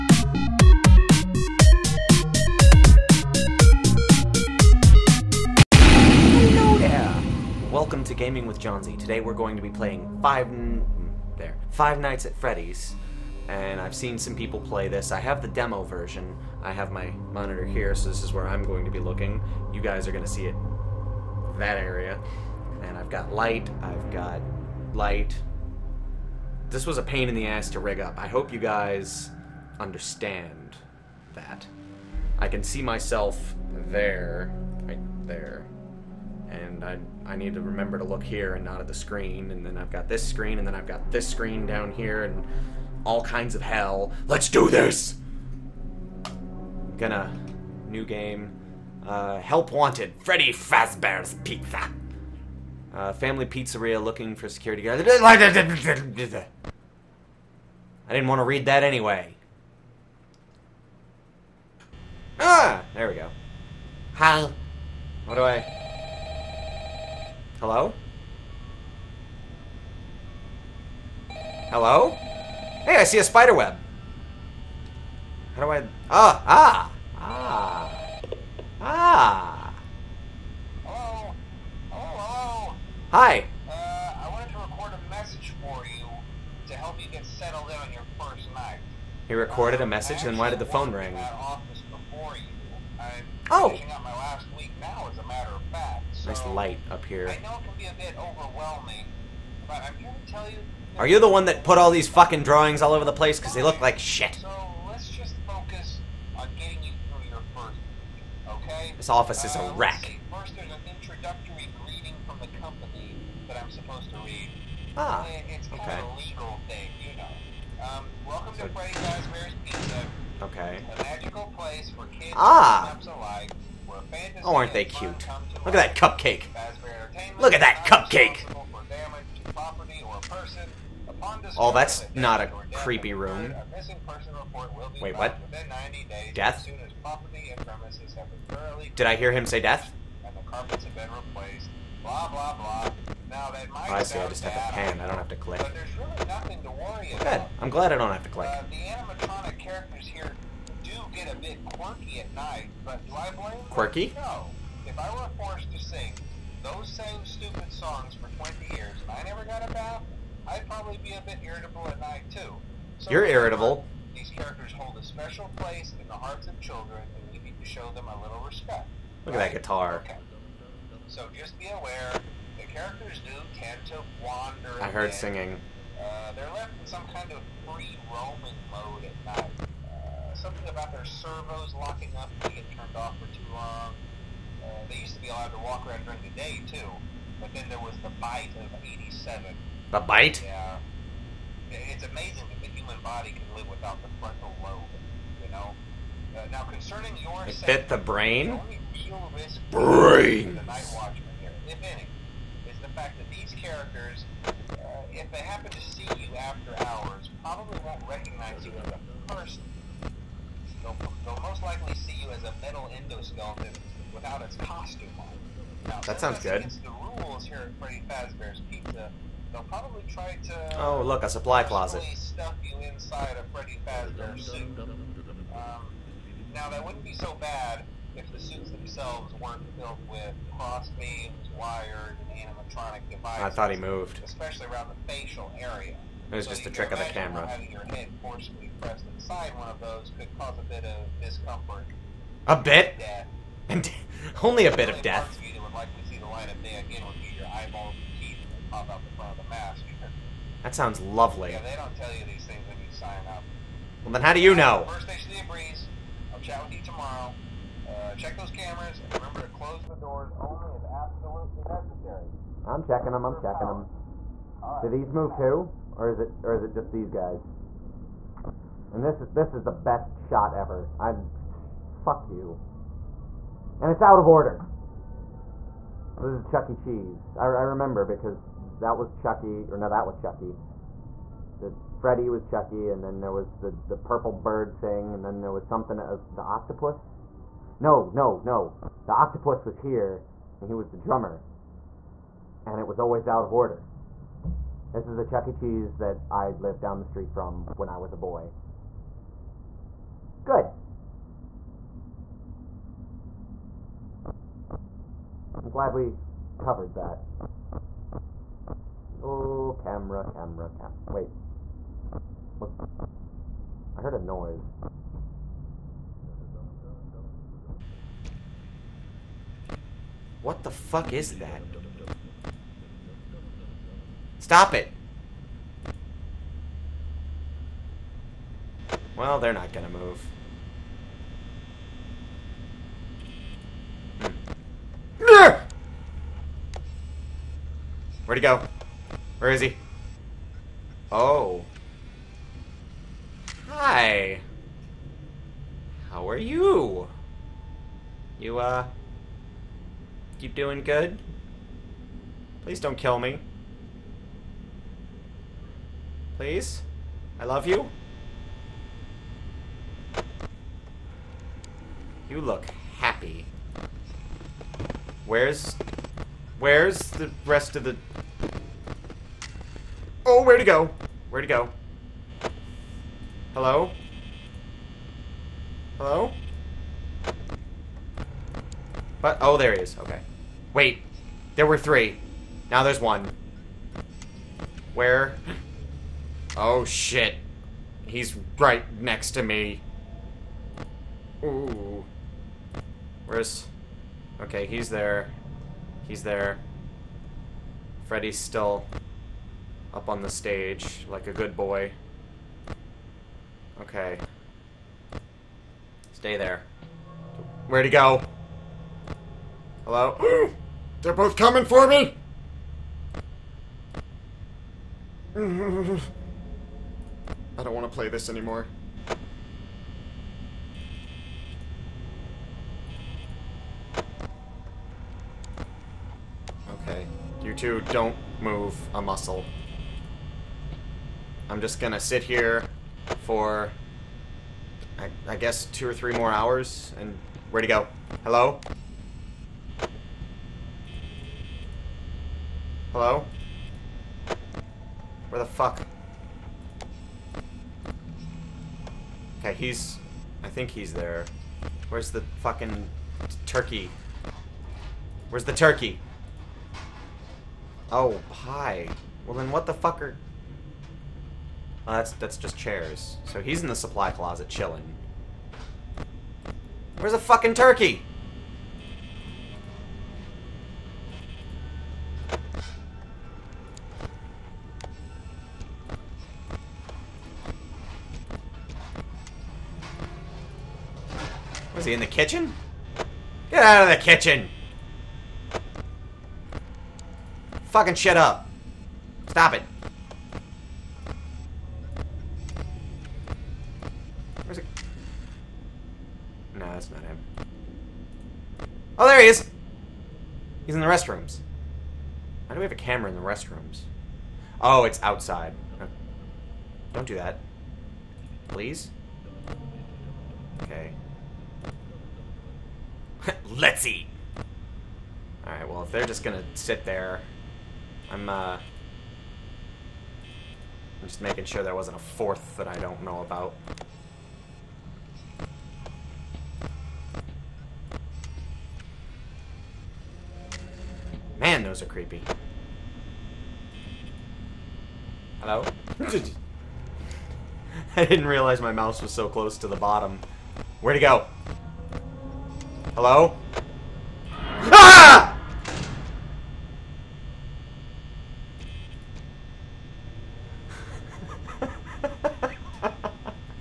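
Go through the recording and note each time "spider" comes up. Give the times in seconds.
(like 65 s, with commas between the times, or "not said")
73 s.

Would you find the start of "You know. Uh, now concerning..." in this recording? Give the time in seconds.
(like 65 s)
195 s.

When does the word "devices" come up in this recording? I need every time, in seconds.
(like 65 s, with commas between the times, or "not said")
233 s.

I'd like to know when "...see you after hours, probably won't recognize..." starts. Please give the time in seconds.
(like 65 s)
205 s.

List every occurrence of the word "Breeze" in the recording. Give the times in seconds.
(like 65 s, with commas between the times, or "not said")
255 s.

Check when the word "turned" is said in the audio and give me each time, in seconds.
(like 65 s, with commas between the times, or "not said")
182 s.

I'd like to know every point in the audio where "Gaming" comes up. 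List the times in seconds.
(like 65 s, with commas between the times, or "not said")
8 s.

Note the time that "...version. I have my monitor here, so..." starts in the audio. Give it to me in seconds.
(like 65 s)
15 s.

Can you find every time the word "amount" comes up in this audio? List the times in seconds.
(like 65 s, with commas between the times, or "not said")
not said.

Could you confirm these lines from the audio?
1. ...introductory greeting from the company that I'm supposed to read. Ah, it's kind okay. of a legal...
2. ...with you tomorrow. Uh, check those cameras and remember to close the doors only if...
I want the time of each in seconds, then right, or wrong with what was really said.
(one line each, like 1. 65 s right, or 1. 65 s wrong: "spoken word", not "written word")
1. 110 s right
2. 256 s right.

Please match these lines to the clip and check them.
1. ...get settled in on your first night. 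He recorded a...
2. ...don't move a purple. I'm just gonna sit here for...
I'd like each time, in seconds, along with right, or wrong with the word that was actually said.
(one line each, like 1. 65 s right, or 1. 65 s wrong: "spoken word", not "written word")
1. 87 s right
2. 427 s wrong: "muscle", not "purple".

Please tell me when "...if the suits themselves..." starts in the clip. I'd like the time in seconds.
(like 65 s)
228 s.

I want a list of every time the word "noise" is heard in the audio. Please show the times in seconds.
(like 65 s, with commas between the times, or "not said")
314 s.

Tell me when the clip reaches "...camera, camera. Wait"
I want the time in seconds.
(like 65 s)
310 s.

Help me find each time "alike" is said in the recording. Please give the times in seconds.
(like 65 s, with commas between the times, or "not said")
123 s.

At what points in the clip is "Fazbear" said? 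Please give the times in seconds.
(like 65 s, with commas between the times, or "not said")
50 s, 118 s, 218 s.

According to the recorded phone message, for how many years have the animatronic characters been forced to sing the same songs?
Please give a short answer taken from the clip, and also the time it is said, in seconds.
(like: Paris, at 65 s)
20, at 158 s.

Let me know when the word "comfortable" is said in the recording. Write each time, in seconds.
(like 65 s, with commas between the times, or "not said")
not said.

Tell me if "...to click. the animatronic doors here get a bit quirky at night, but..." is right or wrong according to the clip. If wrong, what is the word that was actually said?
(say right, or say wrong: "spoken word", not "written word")
wrong: "characters", not "doors".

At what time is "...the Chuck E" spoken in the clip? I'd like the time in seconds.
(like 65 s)
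295 s.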